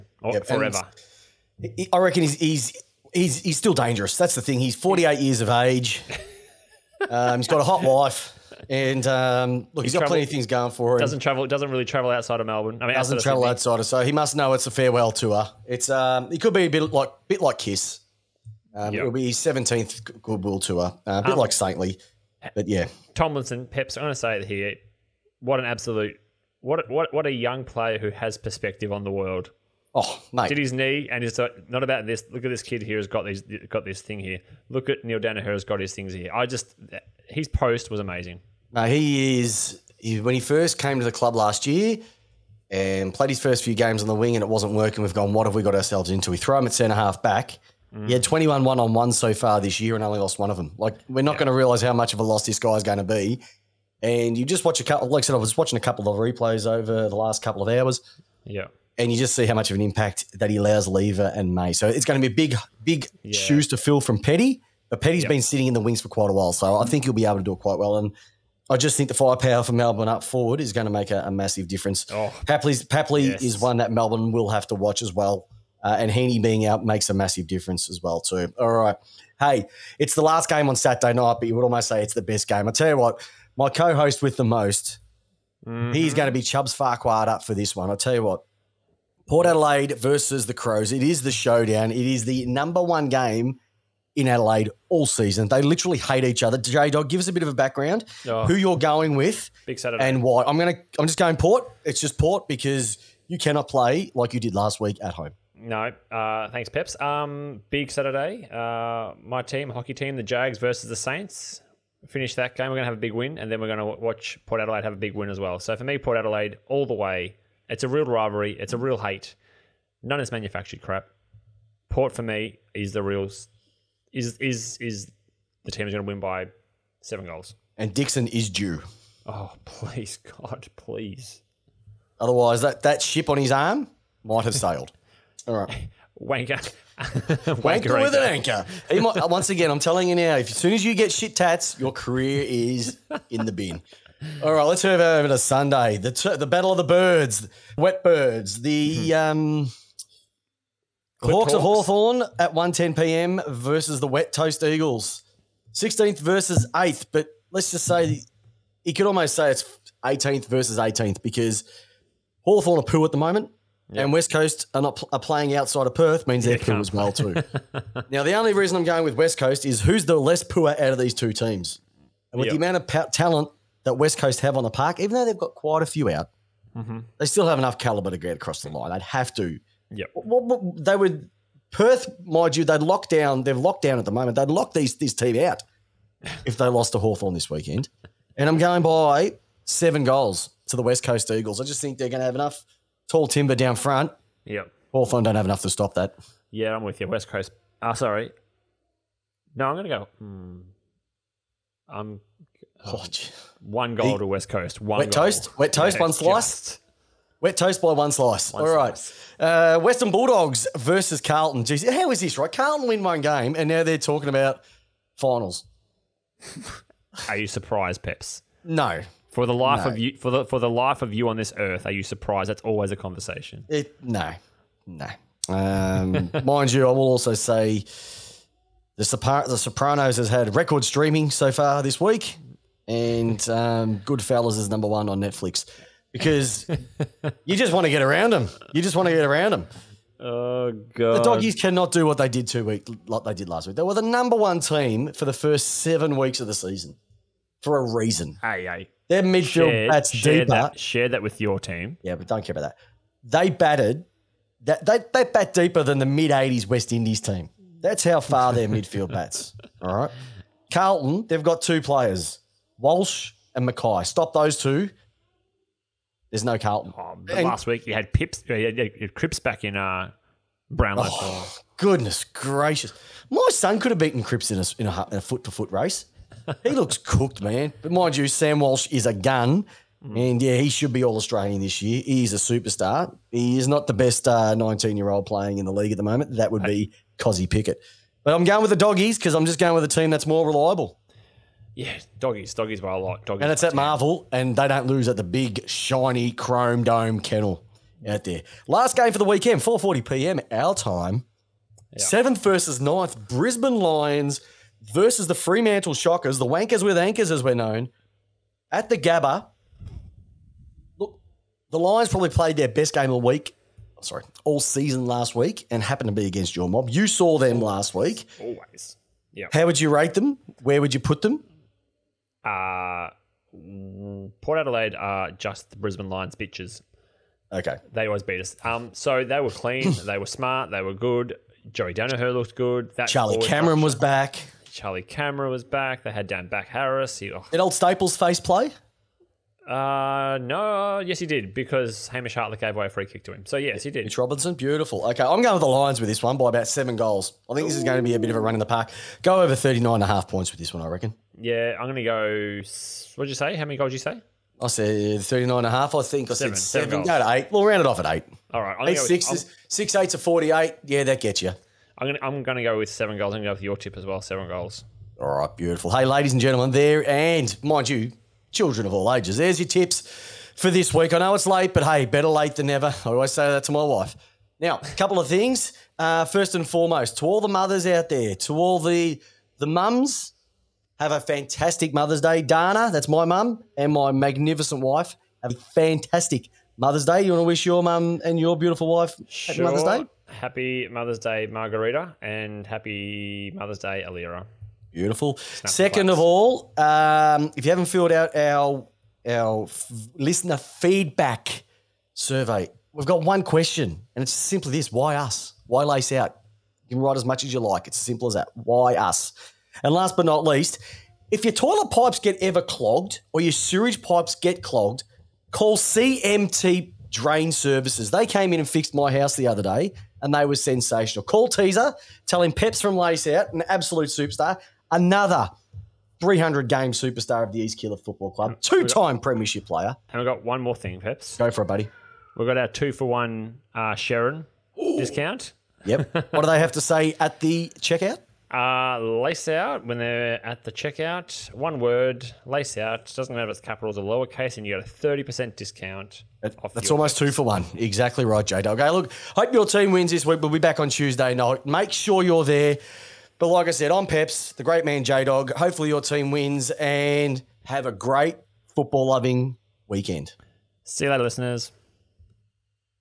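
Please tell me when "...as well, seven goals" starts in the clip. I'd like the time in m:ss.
6:03.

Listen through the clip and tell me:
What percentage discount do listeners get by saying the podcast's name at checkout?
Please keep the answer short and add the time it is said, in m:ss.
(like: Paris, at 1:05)
30%, at 7:24.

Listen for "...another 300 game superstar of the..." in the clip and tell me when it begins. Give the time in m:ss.
7:04.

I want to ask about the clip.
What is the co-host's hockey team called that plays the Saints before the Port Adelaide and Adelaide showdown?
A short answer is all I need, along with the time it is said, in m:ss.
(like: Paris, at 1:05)
The Jags, at 1:50.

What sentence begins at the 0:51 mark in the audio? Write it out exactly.
going to realize how much of a loss this guy is going to be.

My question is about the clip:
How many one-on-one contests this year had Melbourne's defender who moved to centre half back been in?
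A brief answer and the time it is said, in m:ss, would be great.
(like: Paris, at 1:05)
21, at 0:48.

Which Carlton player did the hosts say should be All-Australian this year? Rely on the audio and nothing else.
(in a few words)
Sam Walsh.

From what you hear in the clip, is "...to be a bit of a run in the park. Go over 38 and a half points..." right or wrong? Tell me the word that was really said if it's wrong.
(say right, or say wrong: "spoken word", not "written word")
wrong: "39", not "38".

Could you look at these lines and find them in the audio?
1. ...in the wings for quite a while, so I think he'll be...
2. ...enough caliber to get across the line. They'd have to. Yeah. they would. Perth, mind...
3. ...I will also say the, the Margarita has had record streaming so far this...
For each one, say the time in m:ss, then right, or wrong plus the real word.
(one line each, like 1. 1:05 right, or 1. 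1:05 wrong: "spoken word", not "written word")
1. 1:05 right
2. 2:57 right
3. 3:46 wrong: "Sopranos", not "Margarita".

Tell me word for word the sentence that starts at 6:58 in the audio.
They came in and fixed my house the other day and they were sensational.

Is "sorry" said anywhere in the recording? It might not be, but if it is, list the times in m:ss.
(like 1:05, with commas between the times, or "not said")
3:17, 5:14.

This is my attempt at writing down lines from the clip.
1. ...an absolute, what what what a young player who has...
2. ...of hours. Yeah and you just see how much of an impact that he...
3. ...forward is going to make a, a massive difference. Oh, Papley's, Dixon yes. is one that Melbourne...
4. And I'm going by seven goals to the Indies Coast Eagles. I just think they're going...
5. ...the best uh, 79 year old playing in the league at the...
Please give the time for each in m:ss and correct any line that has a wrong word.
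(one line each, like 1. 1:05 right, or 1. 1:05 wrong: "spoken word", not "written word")
1. 0:25 right
2. 0:57 right
3. 1:10 wrong: "Papley", not "Dixon"
4. 3:08 wrong: "West", not "Indies"
5. 4:43 wrong: "19", not "79".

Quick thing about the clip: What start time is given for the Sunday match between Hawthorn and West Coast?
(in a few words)
1.10 p.m.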